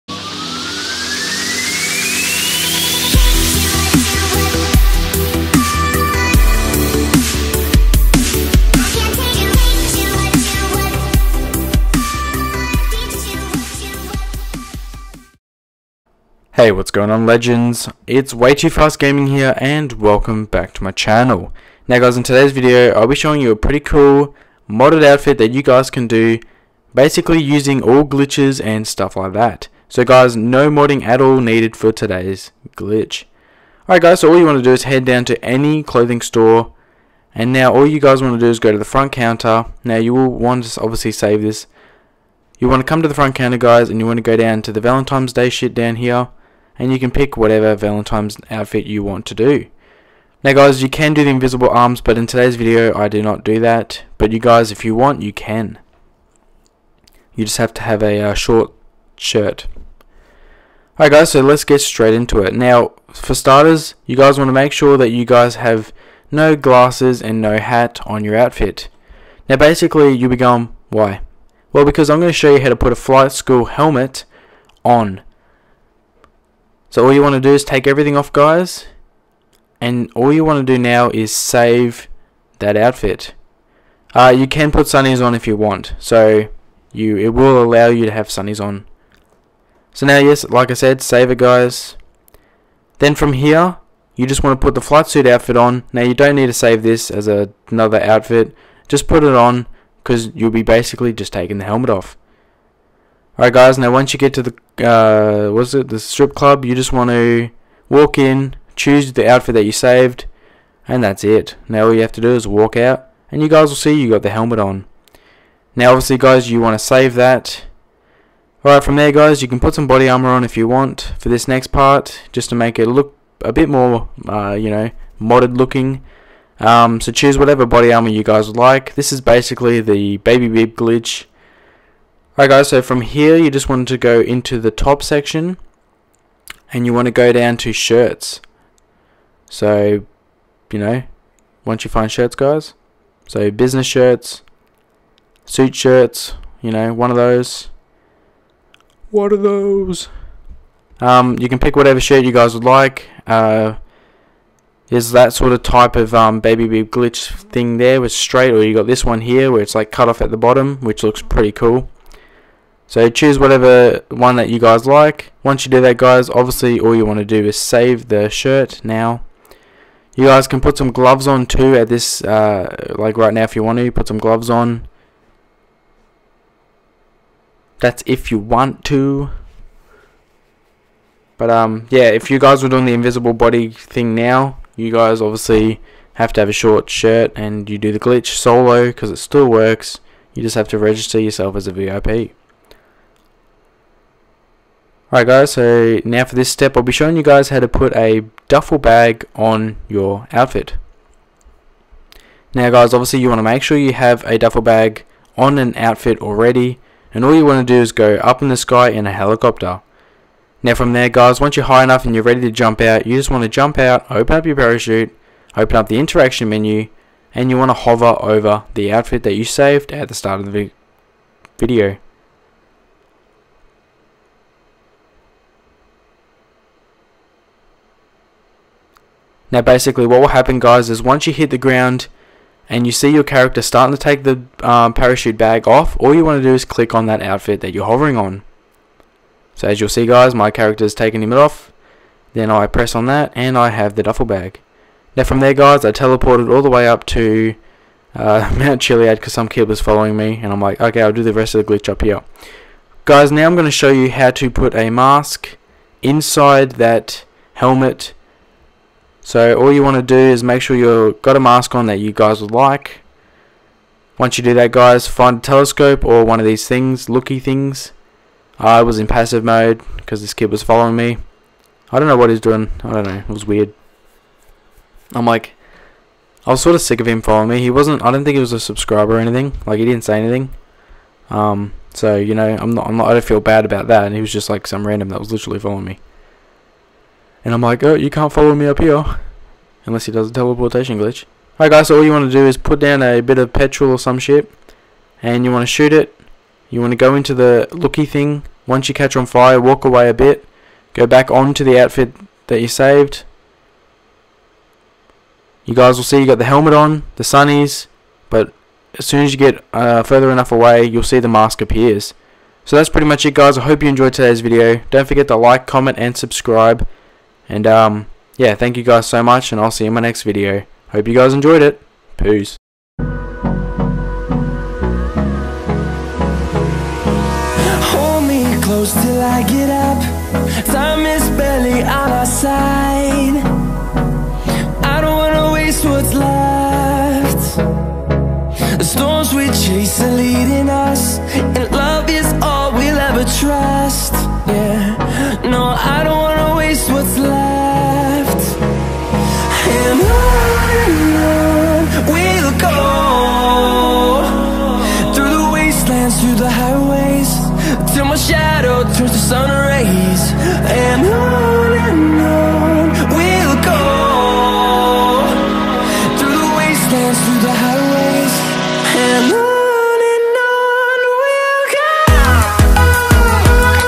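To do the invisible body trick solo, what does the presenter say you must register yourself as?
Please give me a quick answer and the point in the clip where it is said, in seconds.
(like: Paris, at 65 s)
VIP, at 191 s.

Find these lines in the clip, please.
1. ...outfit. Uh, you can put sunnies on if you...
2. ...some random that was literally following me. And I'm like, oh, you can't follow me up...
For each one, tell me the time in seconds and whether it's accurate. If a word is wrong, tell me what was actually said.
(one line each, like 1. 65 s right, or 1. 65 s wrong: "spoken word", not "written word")
1. 82 s right
2. 284 s right.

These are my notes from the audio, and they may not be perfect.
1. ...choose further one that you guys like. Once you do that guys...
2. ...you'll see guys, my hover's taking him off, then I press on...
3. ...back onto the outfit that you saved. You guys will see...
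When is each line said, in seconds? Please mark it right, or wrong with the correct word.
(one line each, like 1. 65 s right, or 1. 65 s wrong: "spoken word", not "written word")
1. 163 s wrong: "whatever", not "further"
2. 239 s wrong: "character", not "hover"
3. 301 s right.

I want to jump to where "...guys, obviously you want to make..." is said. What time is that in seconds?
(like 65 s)
202 s.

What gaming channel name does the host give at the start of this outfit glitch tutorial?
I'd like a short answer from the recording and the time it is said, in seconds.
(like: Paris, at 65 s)
Way2Fast Gaming, at 18 s.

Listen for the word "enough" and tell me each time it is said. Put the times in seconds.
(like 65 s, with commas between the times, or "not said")
211 s, 310 s.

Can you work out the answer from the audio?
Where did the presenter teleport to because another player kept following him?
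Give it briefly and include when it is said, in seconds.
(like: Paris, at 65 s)
Mount Chiliad, at 248 s.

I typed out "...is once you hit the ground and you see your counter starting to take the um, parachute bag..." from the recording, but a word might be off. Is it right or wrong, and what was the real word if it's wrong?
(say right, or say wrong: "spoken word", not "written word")
wrong: "character", not "counter".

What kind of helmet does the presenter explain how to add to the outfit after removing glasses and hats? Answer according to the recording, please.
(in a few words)
flight school helmet.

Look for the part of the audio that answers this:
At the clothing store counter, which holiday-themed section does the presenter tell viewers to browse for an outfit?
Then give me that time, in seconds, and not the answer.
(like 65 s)
44 s.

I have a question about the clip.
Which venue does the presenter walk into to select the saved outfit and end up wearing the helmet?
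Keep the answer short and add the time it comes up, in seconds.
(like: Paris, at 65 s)
the strip club, at 105 s.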